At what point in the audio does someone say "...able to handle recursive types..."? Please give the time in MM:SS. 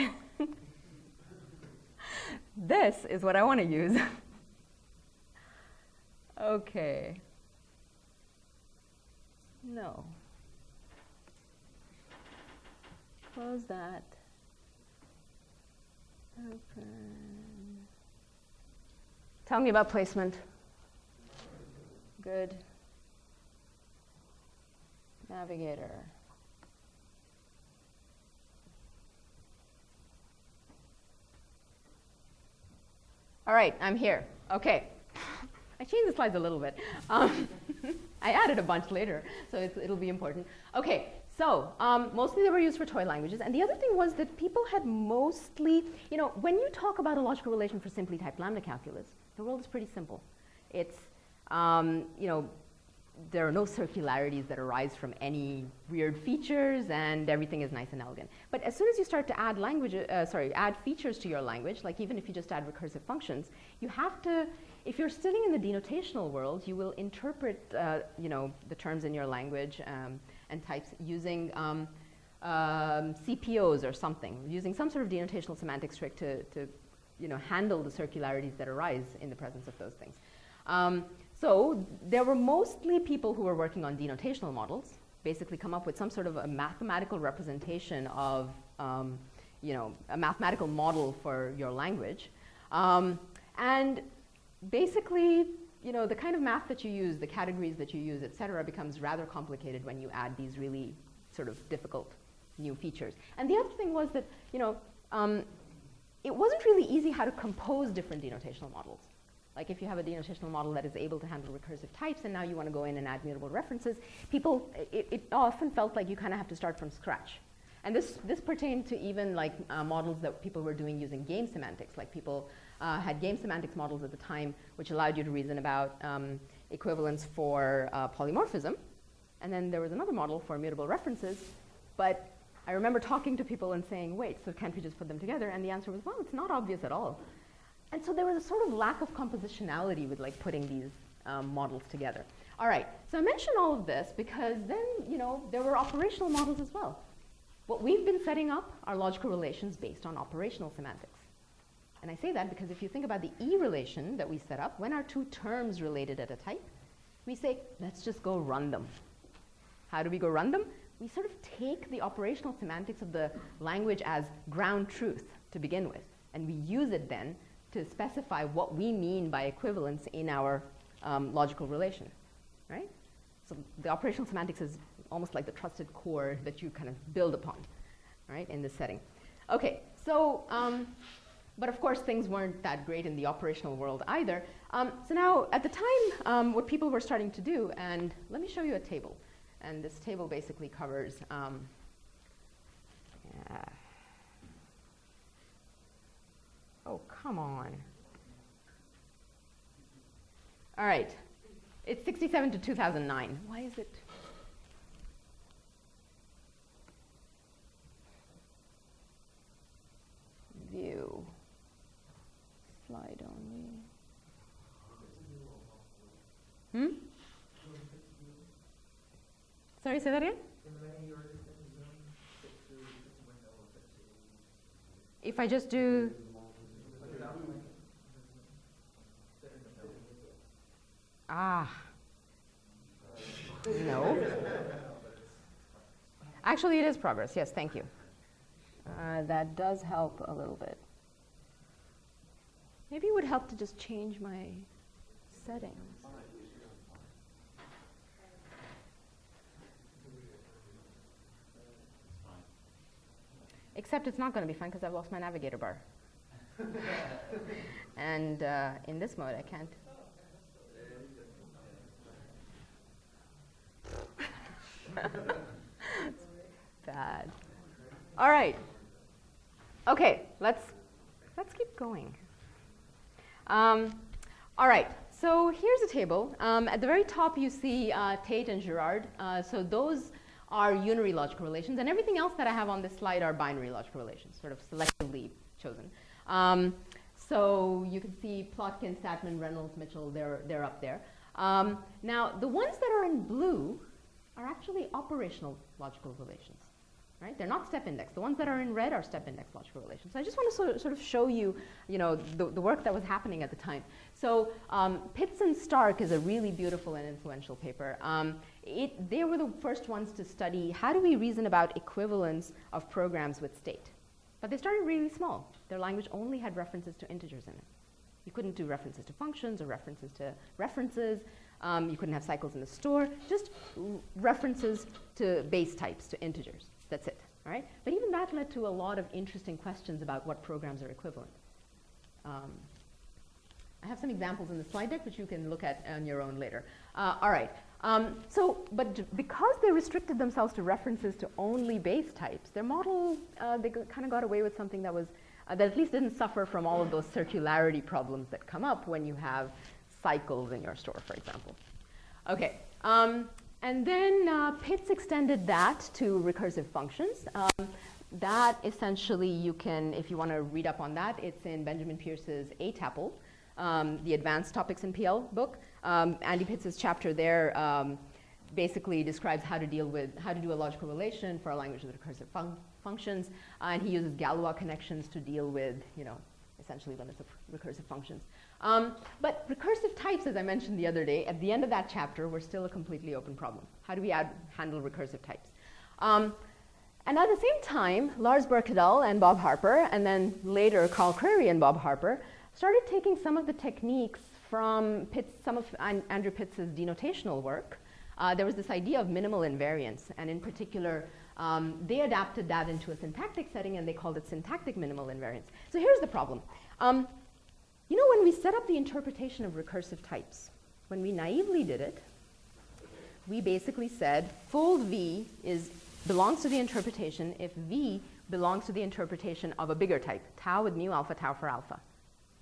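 01:50.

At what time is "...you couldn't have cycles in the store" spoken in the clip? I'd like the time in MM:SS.
05:21.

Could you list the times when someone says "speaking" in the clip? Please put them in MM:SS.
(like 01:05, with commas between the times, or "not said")
not said.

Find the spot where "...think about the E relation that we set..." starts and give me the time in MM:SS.
02:32.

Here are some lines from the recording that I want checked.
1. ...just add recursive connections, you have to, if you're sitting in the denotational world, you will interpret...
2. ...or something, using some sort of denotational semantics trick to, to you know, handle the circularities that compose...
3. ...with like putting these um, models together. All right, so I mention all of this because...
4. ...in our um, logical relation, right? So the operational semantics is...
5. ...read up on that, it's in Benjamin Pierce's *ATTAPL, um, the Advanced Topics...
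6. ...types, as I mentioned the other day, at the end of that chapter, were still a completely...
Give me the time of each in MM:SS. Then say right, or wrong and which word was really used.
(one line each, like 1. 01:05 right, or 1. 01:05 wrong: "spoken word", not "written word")
1. 01:02 wrong: "functions", not "connections"
2. 01:13 wrong: "arise", not "compose"
3. 02:20 right
4. 02:50 right
5. 06:00 right
6. 06:19 right.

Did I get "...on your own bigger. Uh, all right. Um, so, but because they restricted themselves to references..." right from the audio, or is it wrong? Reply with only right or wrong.
wrong.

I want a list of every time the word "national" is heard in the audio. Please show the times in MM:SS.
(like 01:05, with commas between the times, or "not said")
not said.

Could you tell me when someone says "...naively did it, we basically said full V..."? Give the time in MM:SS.
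06:51.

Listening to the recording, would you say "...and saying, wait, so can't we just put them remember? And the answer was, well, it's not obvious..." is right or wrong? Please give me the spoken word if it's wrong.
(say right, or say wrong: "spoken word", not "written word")
wrong: "together", not "remember".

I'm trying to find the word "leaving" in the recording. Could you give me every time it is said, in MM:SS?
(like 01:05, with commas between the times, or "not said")
not said.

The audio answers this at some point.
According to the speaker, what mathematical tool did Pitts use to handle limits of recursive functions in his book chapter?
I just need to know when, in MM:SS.
06:14.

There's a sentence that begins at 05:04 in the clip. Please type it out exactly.
So um, Pitts and Stark is a really beautiful and influential paper.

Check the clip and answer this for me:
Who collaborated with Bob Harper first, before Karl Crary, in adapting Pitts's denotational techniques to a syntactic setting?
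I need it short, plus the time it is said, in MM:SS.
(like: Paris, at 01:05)
Lars Birkedal, at 06:28.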